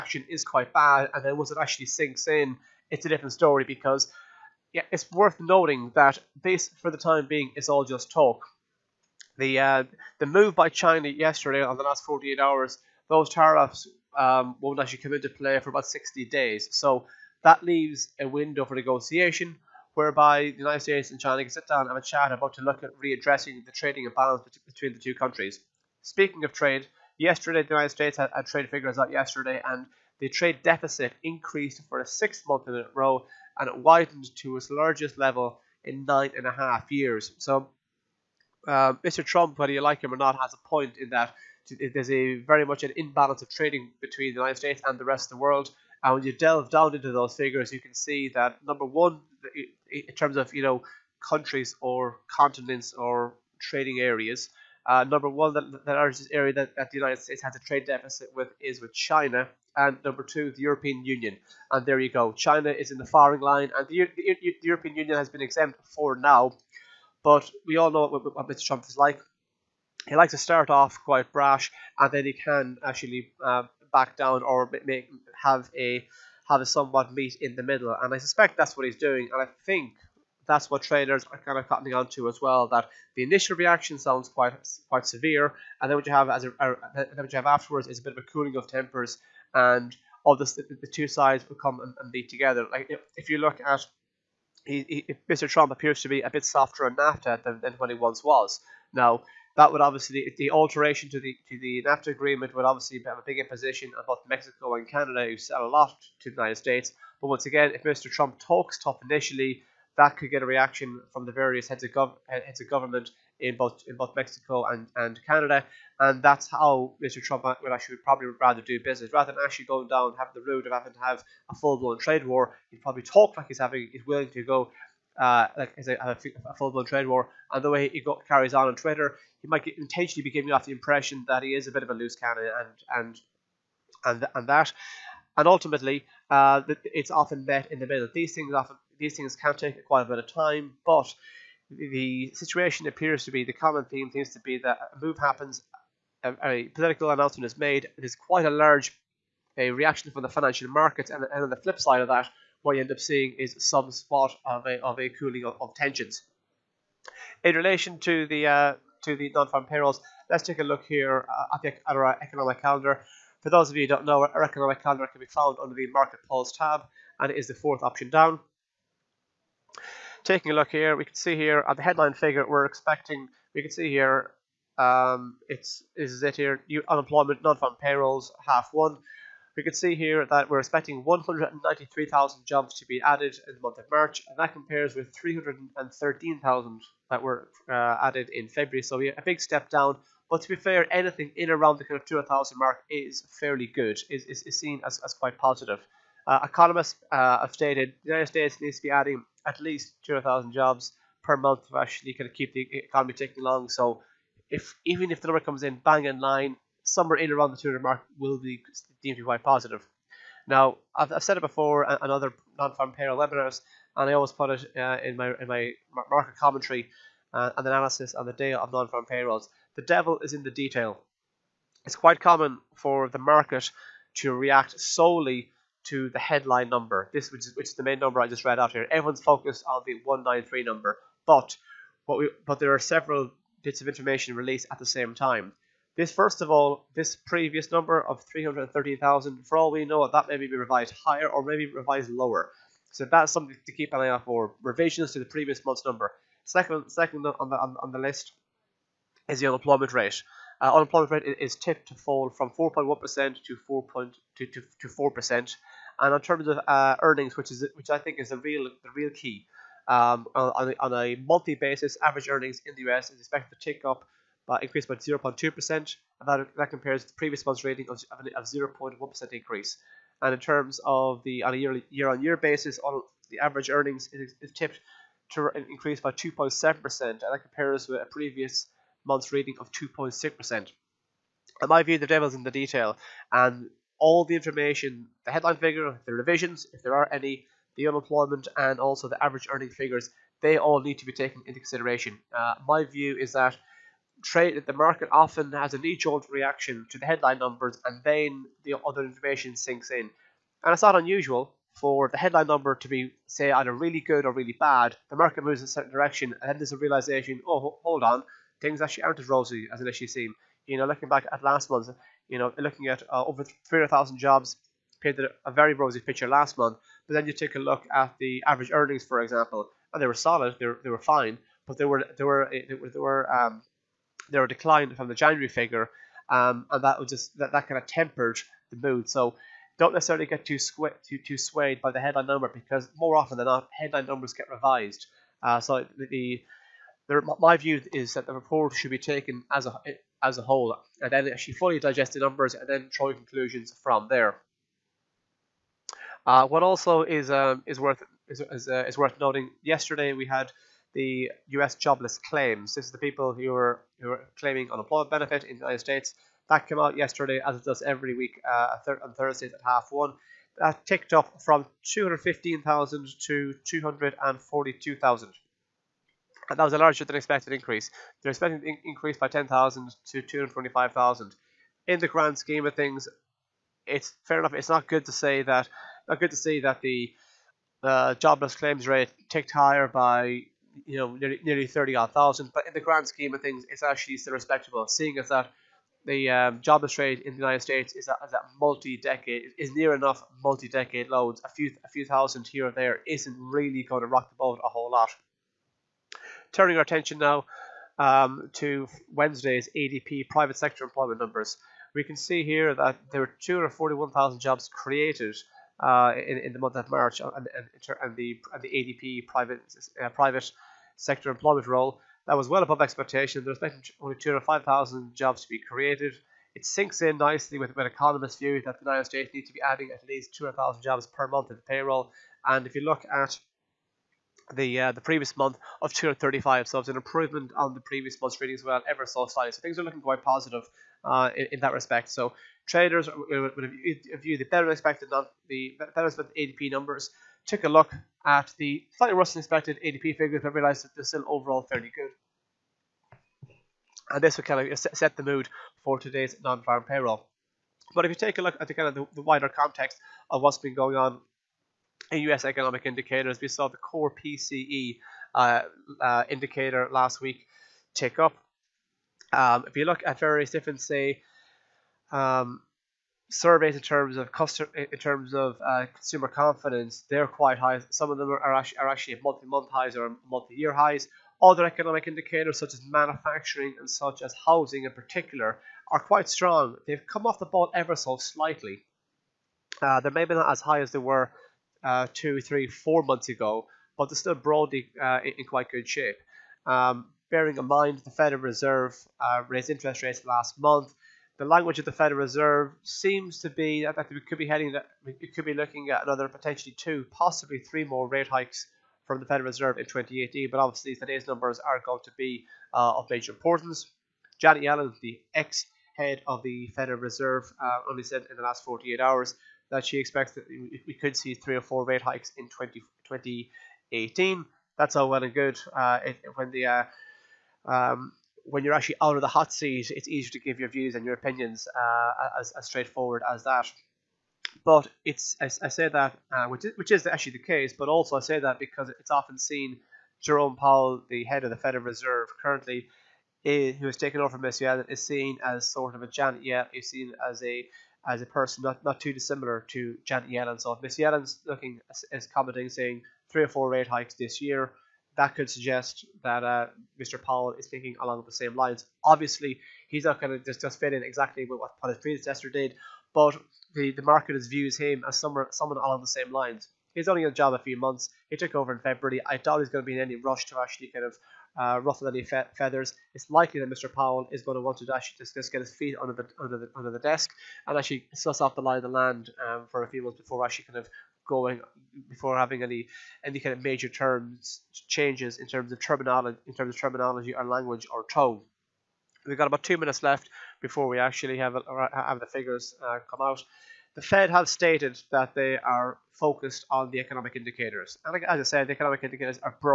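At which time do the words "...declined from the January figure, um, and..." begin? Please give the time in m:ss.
5:24.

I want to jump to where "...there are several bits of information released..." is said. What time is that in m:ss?
3:52.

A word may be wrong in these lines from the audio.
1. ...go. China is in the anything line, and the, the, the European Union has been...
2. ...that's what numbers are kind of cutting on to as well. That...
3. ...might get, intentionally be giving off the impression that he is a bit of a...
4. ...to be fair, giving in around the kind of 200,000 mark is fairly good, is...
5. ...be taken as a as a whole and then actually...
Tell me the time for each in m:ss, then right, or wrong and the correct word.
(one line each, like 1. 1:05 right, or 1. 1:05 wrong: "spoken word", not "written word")
1. 1:02 wrong: "firing", not "anything"
2. 1:20 wrong: "traders", not "numbers"
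3. 2:09 right
4. 3:10 wrong: "anything", not "giving"
5. 5:38 right.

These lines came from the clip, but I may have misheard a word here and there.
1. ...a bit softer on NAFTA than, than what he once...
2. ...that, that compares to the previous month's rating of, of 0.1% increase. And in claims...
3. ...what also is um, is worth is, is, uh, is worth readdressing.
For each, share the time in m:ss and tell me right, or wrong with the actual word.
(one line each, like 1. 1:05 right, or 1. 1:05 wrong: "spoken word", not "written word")
1. 1:36 right
2. 4:26 wrong: "terms", not "claims"
3. 5:46 wrong: "noting", not "readdressing".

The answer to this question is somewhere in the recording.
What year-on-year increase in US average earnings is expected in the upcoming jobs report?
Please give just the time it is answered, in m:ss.
4:36.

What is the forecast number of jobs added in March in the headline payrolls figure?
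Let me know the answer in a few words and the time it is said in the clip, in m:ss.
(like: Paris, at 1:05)
193,000, at 3:01.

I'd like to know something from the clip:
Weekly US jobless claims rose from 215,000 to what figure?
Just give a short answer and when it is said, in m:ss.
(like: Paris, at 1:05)
242,000, at 6:03.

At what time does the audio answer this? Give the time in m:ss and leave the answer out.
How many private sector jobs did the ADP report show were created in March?
6:43.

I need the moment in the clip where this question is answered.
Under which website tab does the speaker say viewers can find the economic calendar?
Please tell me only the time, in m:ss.
2:45.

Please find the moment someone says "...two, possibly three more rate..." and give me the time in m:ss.
8:16.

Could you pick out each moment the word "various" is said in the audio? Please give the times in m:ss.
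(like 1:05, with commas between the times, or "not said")
1:51, 7:40.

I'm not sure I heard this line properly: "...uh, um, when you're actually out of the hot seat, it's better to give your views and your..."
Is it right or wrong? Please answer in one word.
wrong.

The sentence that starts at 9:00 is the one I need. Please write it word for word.
So if Miss Yellen's looking is commenting saying three or four rate hikes this year, that could suggest that uh, Mr.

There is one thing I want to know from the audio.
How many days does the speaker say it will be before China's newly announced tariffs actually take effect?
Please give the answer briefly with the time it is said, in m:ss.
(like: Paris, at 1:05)
60 days, at 0:15.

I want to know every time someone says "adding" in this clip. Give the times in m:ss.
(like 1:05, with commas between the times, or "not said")
3:18, 6:59.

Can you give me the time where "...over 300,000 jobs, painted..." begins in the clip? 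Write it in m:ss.
5:13.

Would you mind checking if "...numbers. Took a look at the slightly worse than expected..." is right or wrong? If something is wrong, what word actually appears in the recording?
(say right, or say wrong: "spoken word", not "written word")
right.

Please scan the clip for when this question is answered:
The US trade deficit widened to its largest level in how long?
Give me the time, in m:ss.
0:36.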